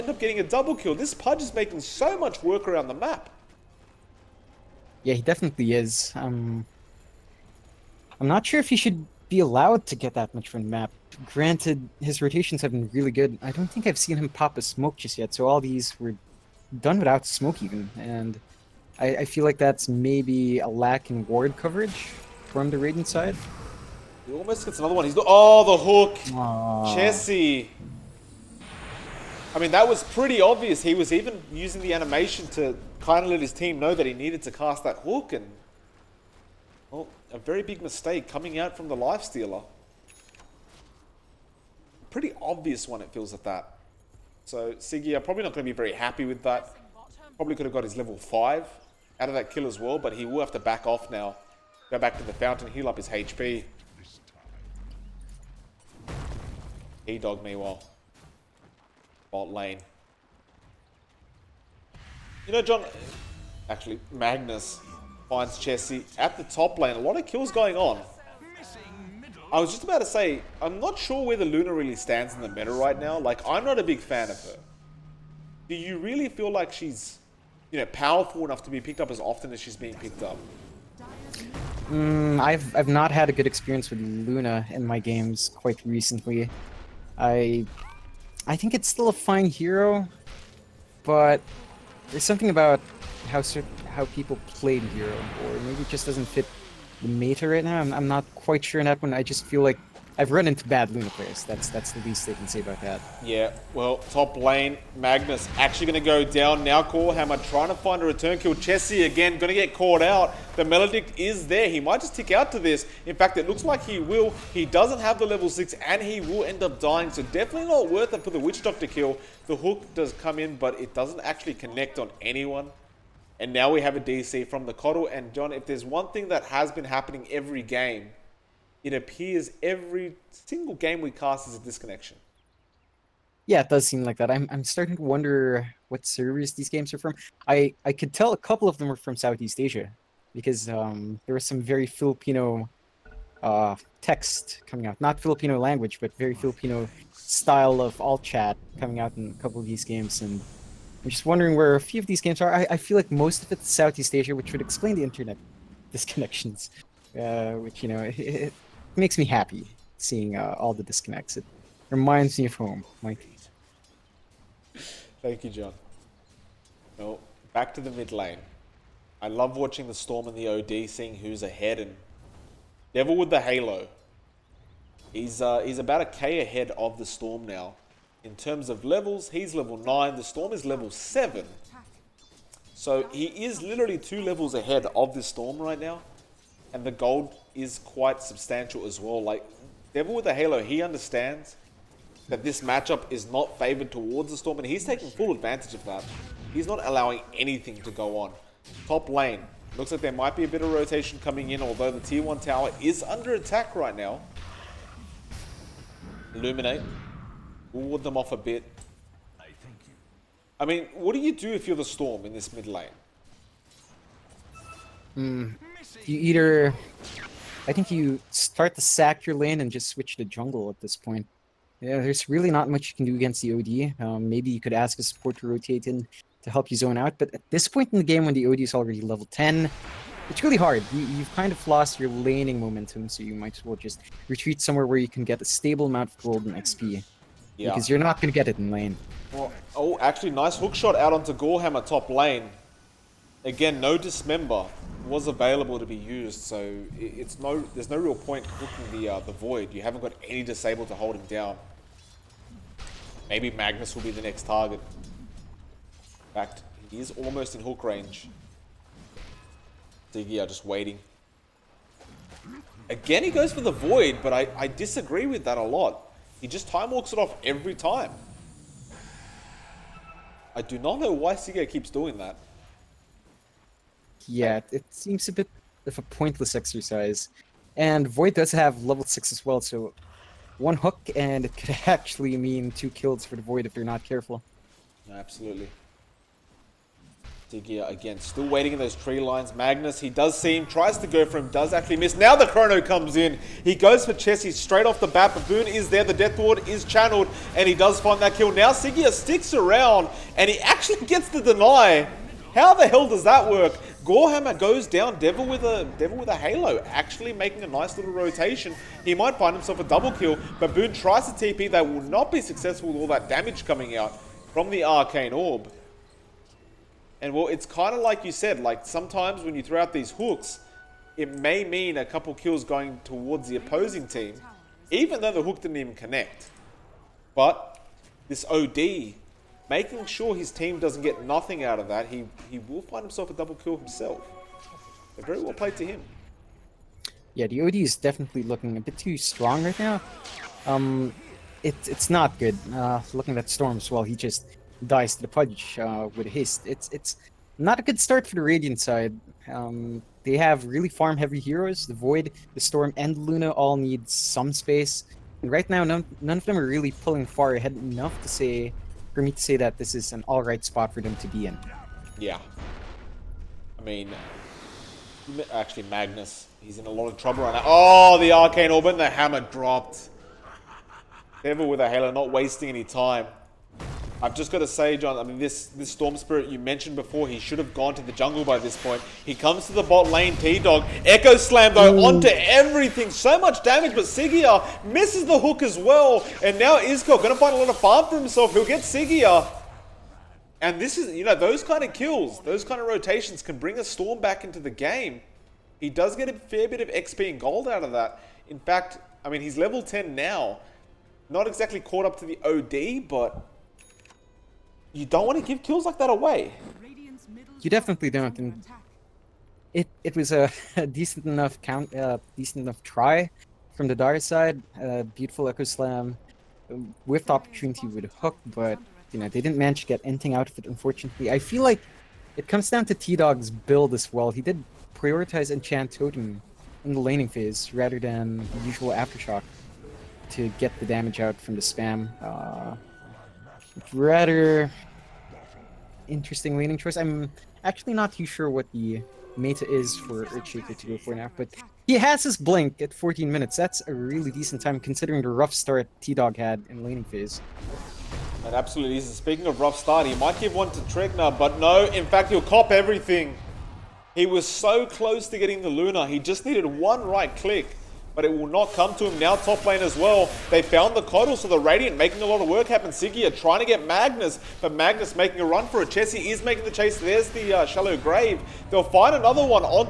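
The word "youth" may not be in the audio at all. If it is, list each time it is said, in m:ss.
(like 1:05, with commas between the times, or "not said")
not said.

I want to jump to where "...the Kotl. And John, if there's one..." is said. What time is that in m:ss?
2:04.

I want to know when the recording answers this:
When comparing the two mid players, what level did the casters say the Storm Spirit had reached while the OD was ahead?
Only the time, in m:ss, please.
3:00.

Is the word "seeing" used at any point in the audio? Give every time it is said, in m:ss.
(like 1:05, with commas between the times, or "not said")
2:39, 2:50.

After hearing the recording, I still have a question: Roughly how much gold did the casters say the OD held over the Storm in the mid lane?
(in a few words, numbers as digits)
about 1K.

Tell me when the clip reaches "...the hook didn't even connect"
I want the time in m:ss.
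5:25.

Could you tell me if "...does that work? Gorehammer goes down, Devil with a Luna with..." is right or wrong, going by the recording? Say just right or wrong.
wrong.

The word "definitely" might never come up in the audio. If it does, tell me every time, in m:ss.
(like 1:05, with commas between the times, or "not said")
0:05, 1:57, 5:37, 6:47.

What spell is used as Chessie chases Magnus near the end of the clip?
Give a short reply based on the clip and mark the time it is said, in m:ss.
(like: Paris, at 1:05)
Shallow Grave, at 7:47.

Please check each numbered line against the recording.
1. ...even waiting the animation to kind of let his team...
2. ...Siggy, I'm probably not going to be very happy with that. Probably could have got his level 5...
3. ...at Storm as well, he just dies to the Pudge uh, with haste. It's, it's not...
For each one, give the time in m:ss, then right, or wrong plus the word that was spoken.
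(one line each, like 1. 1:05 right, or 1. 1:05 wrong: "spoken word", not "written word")
1. 0:31 wrong: "using", not "waiting"
2. 0:44 right
3. 5:43 right.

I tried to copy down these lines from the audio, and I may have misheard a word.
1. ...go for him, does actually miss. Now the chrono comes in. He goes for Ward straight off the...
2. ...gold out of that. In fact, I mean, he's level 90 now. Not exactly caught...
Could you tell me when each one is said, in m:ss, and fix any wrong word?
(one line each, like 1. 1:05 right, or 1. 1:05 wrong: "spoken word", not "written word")
1. 4:51 wrong: "Chessie", not "Ward"
2. 6:37 wrong: "10", not "90".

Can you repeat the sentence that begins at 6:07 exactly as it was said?
Oh, the arcane orb and the hammer dropped.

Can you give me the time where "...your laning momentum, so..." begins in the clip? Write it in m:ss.
3:51.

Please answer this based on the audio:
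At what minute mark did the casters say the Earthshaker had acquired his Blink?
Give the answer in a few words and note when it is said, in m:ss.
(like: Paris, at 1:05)
14, at 7:22.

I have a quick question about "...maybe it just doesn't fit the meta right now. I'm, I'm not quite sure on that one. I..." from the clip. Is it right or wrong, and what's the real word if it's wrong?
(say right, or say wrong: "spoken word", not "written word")
right.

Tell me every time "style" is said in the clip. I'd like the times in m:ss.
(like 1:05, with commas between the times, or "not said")
2:27.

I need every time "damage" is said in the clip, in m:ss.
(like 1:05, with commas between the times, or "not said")
5:13, 6:23, 7:10.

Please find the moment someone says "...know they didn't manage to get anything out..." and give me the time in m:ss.
6:59.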